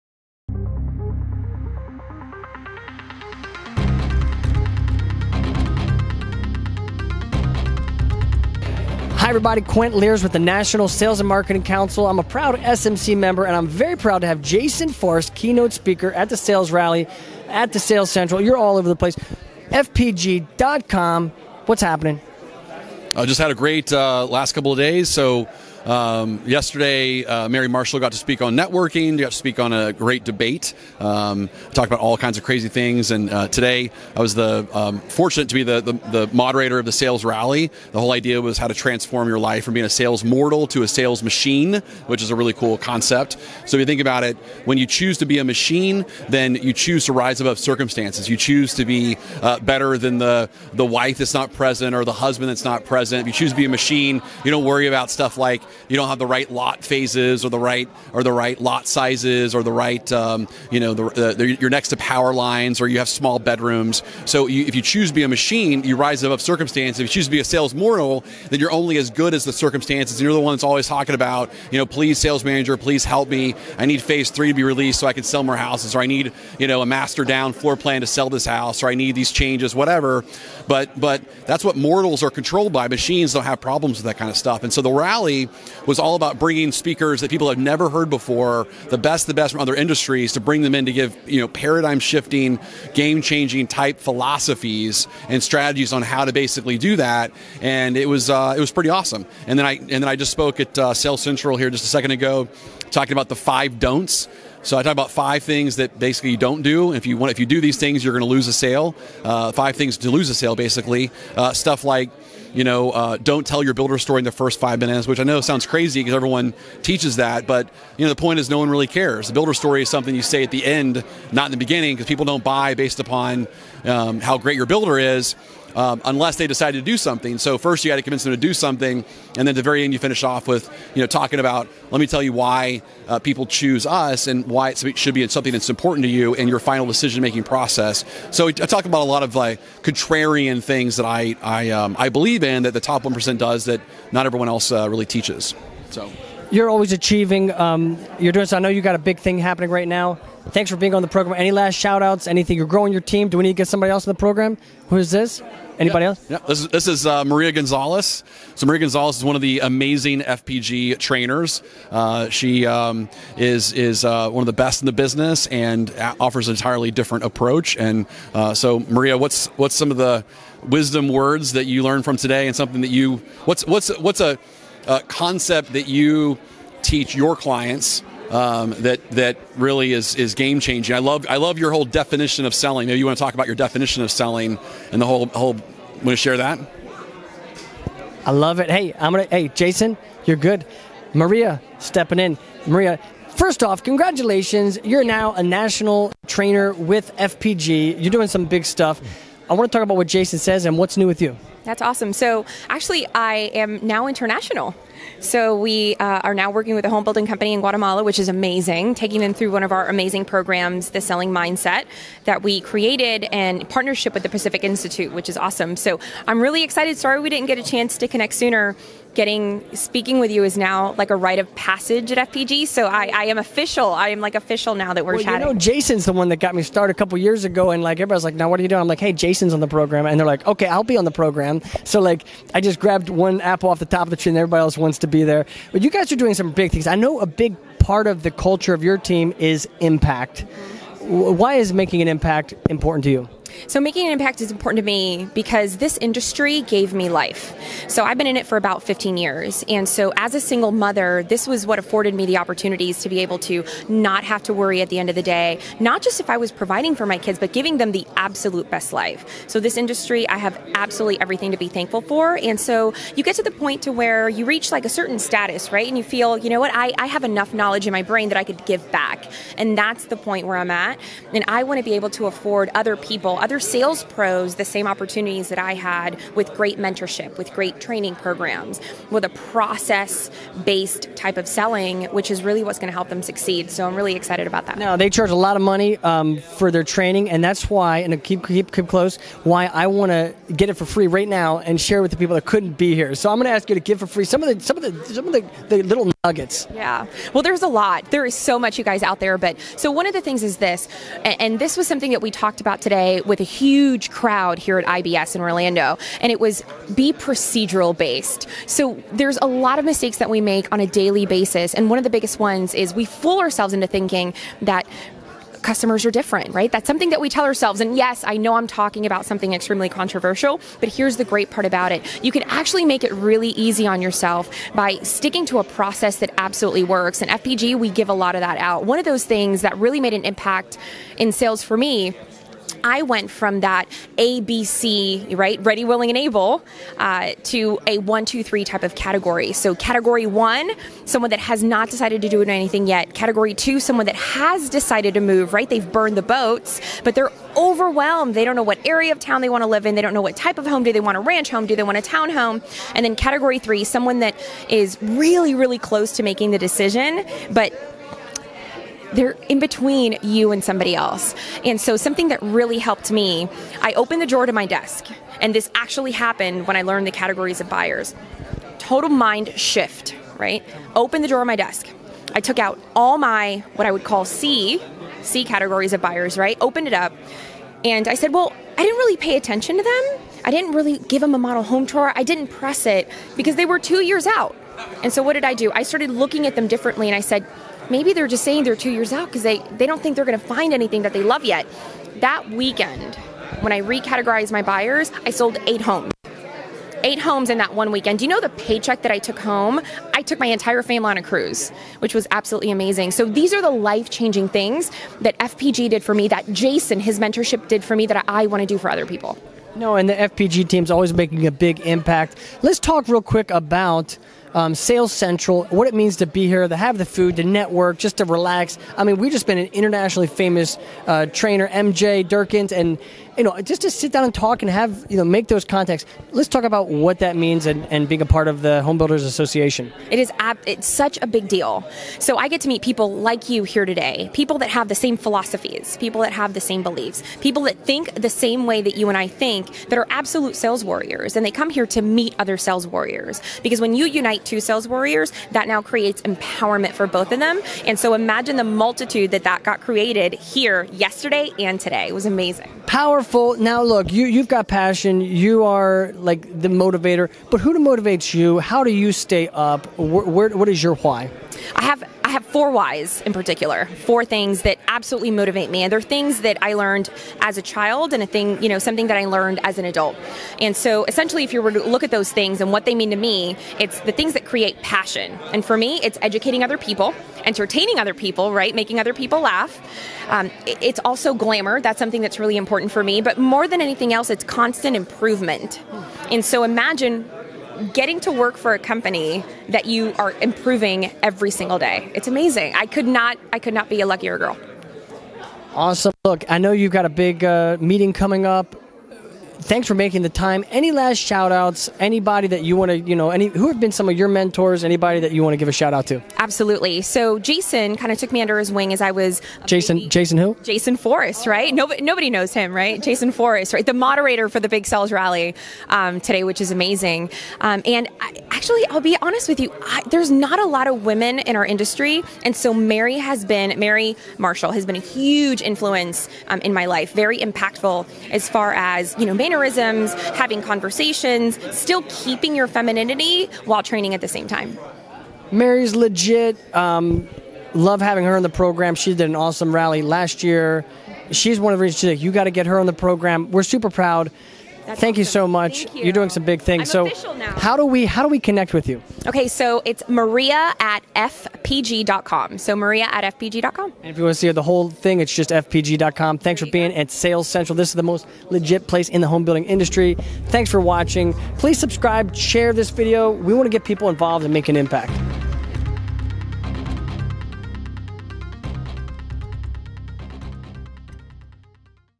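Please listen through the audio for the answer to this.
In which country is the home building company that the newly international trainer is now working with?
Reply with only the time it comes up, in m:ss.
3:27.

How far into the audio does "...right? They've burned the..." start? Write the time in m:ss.
5:45.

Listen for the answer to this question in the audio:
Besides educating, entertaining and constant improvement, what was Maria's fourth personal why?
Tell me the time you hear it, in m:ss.
8:01.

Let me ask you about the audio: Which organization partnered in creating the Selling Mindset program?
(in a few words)
The Pacific Institute.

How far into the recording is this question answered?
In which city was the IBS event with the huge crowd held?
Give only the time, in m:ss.
5:05.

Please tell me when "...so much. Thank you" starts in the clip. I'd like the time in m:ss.
9:05.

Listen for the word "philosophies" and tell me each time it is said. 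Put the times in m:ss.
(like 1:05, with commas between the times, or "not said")
1:33, 7:15.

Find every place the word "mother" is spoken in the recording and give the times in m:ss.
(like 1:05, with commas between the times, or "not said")
4:10.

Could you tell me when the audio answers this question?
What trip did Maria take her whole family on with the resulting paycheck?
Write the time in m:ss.
6:41.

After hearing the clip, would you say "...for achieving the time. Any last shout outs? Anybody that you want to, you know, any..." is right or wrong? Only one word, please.
wrong.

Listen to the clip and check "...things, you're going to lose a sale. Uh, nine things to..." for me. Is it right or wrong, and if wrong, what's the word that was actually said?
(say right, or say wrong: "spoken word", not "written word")
wrong: "five", not "nine".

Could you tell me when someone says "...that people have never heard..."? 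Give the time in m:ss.
1:27.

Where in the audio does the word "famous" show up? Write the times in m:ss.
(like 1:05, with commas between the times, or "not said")
7:00.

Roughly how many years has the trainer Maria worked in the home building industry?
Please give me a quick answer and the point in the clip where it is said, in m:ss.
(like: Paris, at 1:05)
15, at 4:08.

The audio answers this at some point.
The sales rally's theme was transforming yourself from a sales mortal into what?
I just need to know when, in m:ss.
0:40.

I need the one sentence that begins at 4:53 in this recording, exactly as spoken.
So I'm going to ask you to give for free some of the, some of the, some of the, the little nuggets.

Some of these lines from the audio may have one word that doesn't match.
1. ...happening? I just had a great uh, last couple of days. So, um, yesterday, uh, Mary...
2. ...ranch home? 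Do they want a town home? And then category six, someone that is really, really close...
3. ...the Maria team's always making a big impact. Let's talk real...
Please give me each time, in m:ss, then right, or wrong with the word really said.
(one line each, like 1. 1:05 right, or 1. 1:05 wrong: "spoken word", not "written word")
1. 0:21 right
2. 5:51 wrong: "three", not "six"
3. 6:50 wrong: "FPG", not "Maria".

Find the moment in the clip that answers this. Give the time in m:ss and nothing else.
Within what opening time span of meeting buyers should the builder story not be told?
1:54.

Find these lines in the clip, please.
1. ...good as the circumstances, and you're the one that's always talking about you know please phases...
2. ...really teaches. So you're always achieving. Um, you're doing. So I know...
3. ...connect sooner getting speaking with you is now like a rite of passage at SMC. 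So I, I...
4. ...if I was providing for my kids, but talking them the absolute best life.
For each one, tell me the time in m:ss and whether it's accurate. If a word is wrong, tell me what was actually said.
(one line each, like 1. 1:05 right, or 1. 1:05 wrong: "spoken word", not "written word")
1. 1:09 wrong: "sales", not "phases"
2. 2:24 right
3. 3:38 wrong: "FPG", not "SMC"
4. 4:16 wrong: "giving", not "talking".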